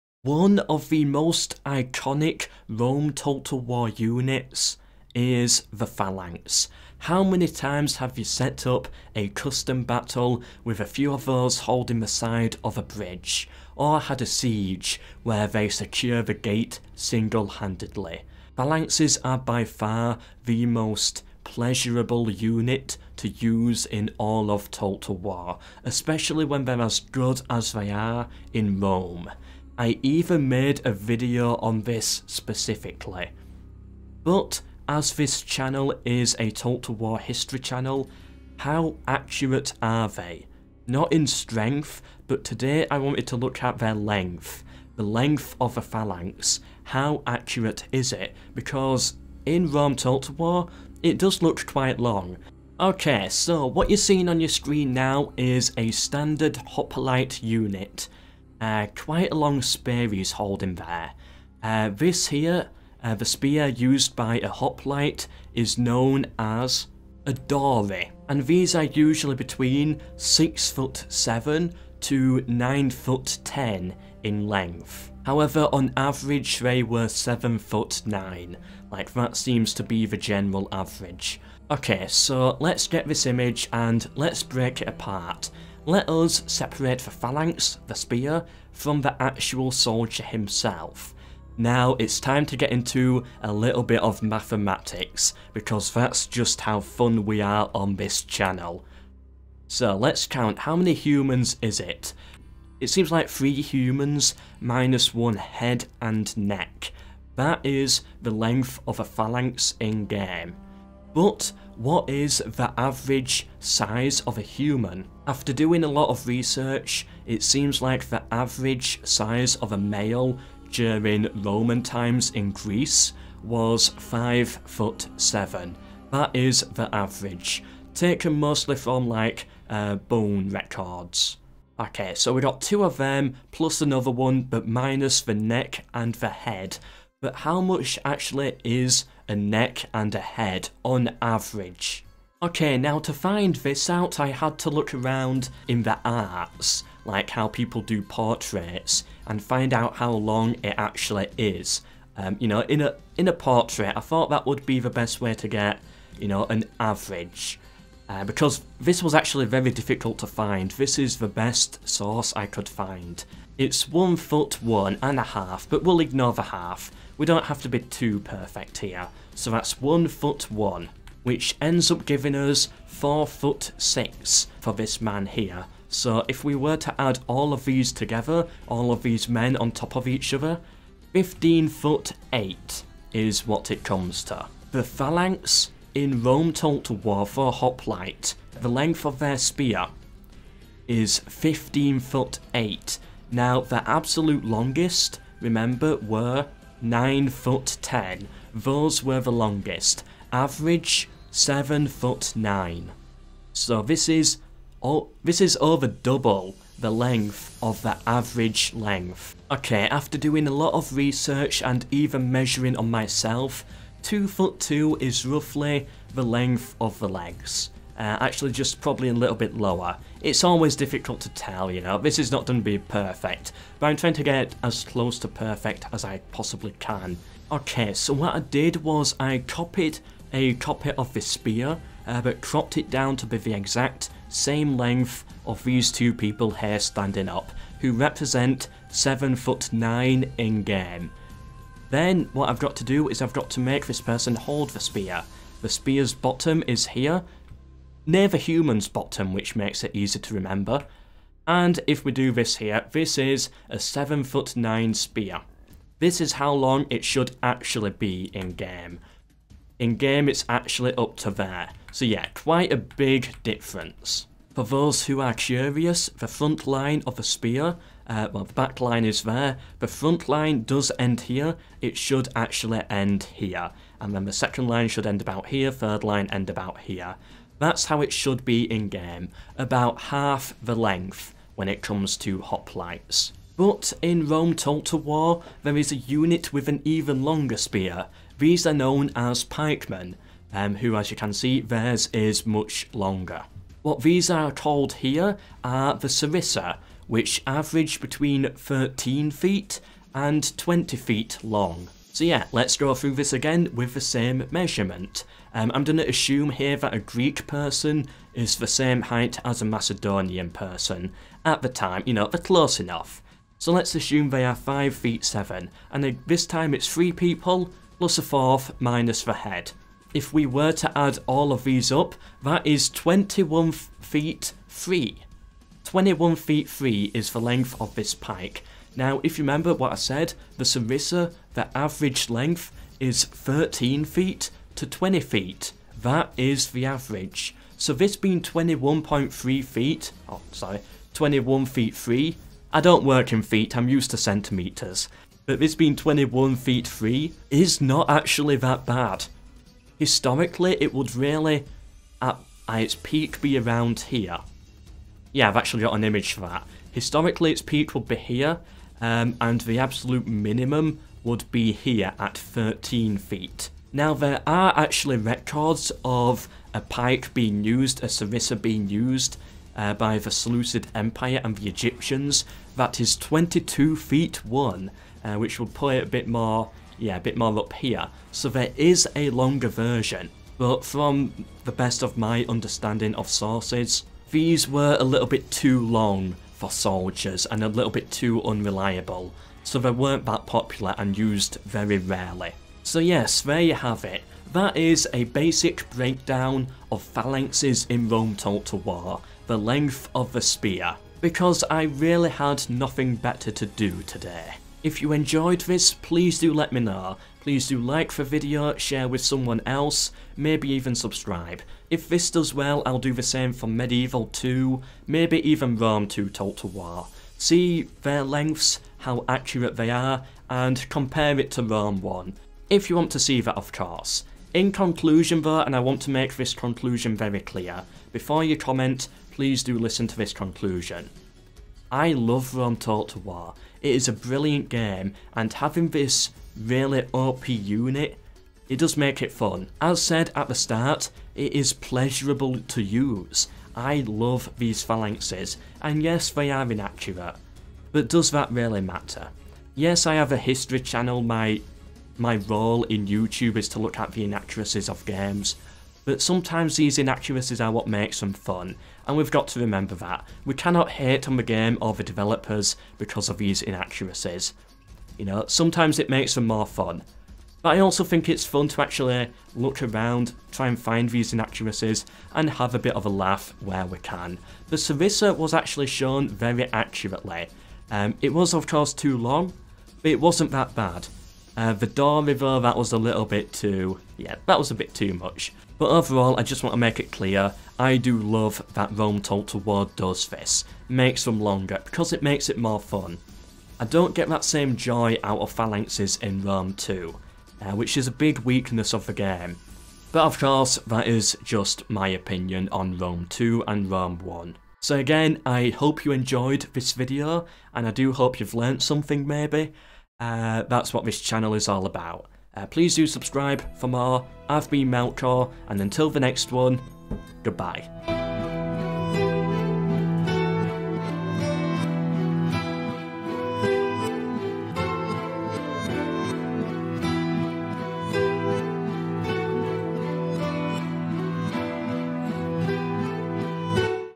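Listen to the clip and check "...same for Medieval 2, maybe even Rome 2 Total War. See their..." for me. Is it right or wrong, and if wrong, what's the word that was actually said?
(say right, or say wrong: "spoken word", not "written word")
right.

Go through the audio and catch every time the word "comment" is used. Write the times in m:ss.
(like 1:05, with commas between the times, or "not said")
7:08.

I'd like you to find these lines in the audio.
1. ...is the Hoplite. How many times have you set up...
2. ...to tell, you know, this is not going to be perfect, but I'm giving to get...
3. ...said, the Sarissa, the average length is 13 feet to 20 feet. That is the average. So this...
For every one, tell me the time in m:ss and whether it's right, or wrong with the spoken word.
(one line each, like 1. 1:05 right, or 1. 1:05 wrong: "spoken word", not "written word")
1. 0:05 wrong: "Phalanx", not "Hoplite"
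2. 3:41 wrong: "trying", not "giving"
3. 5:29 right.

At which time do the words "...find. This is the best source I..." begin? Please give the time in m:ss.
2:40.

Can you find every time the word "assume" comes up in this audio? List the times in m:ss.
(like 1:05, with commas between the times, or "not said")
5:06, 5:13.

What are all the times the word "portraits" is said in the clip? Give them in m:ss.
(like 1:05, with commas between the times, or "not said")
2:28, 2:33.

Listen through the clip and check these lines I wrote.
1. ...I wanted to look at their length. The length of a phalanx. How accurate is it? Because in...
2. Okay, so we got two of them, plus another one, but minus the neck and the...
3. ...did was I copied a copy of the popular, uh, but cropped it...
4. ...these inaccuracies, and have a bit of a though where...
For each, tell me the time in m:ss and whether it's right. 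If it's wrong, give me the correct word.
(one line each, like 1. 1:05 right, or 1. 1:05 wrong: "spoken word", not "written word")
1. 0:42 right
2. 2:11 right
3. 3:48 wrong: "spear", not "popular"
4. 7:51 wrong: "laugh", not "though".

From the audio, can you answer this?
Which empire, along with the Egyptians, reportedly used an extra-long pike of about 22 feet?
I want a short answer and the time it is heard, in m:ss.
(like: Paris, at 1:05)
Seleucid Empire, at 6:10.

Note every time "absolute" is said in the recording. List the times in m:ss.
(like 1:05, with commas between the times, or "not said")
3:13, 5:59.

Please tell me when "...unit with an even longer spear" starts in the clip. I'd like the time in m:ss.
4:45.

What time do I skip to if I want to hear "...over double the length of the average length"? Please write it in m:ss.
3:25.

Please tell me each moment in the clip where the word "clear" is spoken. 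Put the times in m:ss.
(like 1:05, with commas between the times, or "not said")
7:07, 8:07.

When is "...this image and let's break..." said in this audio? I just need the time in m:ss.
1:23.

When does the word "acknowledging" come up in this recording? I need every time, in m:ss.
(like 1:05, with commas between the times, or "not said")
not said.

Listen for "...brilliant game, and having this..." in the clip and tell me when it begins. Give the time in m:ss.
7:14.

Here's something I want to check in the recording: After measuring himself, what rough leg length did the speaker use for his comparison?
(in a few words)
2 foot 2.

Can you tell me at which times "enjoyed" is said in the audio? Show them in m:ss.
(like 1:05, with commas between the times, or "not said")
6:45, 8:26.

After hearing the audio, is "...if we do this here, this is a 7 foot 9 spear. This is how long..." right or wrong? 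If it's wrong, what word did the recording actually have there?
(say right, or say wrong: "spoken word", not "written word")
right.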